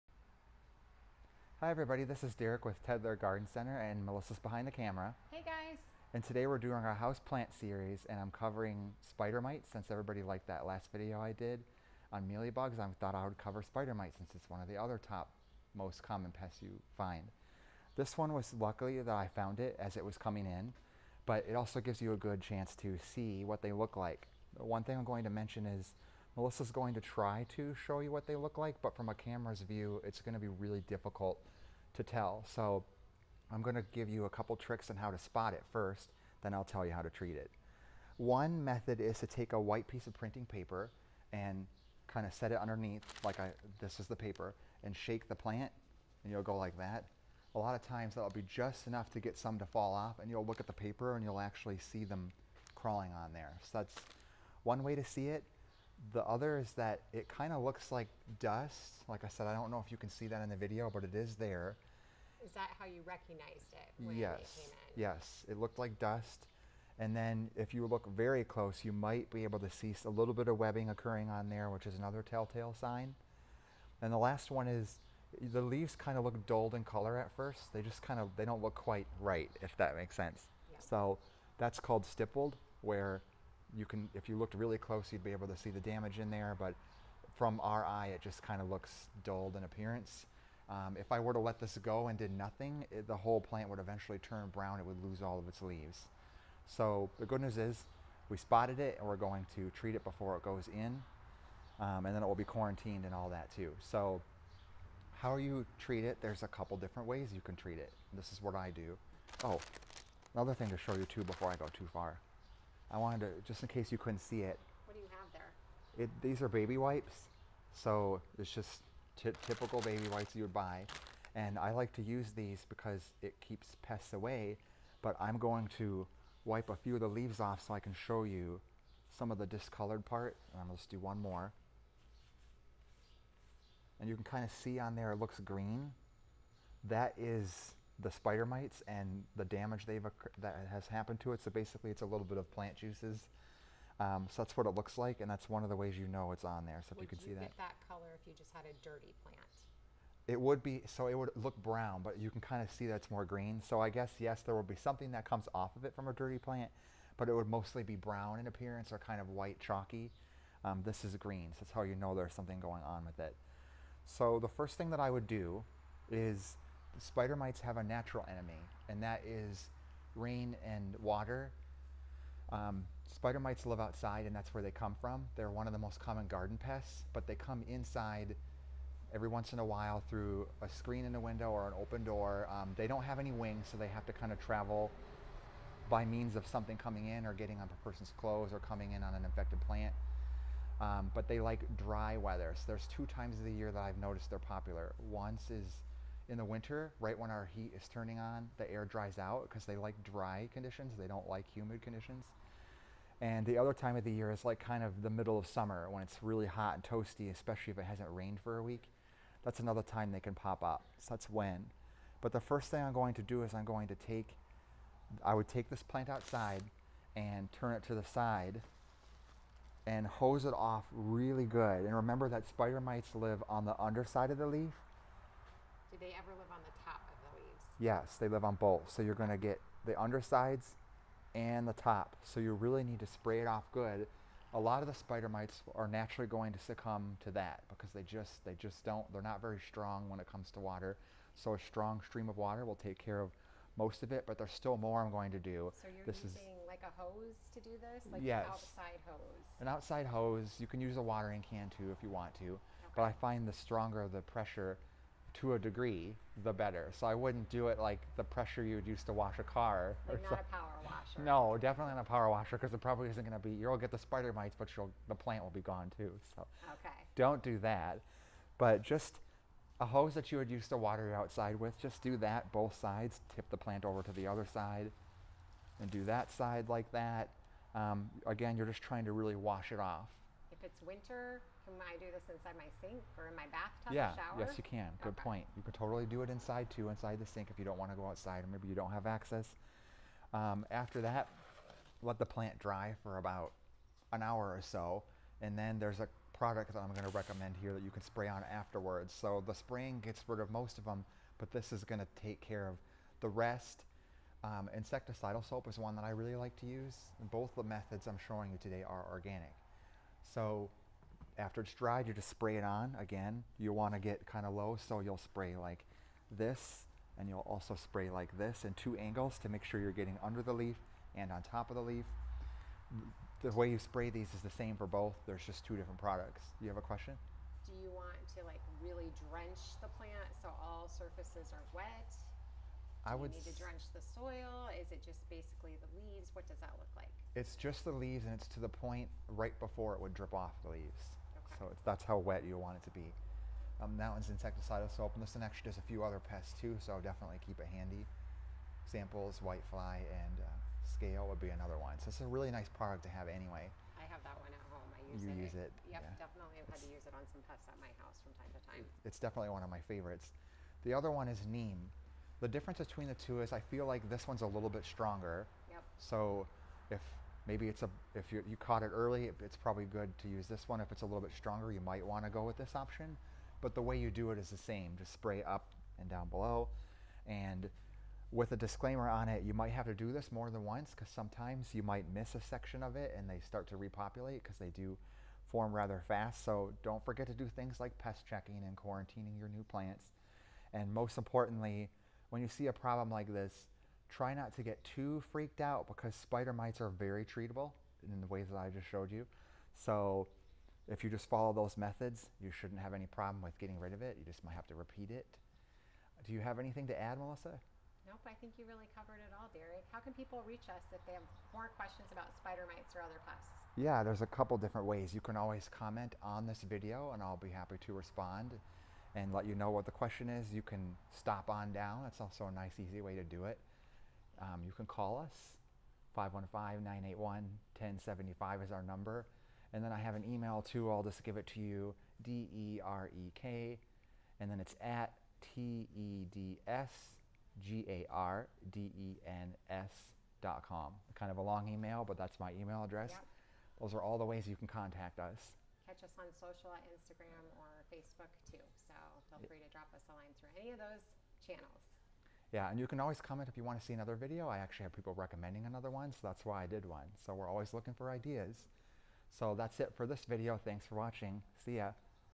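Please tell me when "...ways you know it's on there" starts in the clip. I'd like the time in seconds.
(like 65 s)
145 s.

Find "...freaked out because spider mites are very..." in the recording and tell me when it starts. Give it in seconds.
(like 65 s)
395 s.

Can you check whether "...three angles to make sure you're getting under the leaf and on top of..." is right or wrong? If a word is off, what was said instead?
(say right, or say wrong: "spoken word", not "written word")
wrong: "two", not "three".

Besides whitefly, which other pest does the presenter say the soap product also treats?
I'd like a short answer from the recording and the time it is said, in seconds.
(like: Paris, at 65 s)
Scale, at 350 s.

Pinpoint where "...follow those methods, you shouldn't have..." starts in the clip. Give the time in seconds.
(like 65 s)
401 s.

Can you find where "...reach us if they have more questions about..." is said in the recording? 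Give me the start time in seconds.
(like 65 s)
410 s.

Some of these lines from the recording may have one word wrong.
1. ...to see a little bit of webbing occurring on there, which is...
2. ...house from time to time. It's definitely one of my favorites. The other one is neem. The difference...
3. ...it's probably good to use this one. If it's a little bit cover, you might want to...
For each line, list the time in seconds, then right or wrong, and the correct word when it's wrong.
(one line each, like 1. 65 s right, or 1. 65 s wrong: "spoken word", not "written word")
1. 69 s right
2. 357 s right
3. 369 s wrong: "stronger", not "cover".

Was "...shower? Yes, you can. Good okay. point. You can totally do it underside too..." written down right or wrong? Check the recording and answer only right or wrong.
wrong.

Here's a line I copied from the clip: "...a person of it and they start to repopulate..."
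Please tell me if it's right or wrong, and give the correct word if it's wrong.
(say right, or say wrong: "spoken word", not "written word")
wrong: "section", not "person".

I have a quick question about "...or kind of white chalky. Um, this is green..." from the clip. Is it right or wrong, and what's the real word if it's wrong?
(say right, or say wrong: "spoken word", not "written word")
right.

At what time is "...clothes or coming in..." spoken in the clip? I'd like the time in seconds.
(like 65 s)
188 s.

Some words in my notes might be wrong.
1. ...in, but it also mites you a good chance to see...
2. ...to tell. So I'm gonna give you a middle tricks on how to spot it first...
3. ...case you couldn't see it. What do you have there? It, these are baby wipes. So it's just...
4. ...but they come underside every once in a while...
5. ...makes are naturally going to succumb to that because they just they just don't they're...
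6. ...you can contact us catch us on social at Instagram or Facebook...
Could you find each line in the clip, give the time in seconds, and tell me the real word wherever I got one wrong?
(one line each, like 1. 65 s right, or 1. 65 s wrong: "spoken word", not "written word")
1. 20 s wrong: "gives", not "mites"
2. 31 s wrong: "couple", not "middle"
3. 113 s right
4. 177 s wrong: "inside", not "underside"
5. 235 s wrong: "mites", not "makes"
6. 444 s right.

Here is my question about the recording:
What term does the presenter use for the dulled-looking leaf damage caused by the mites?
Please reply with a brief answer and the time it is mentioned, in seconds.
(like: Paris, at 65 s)
Stippled, at 82 s.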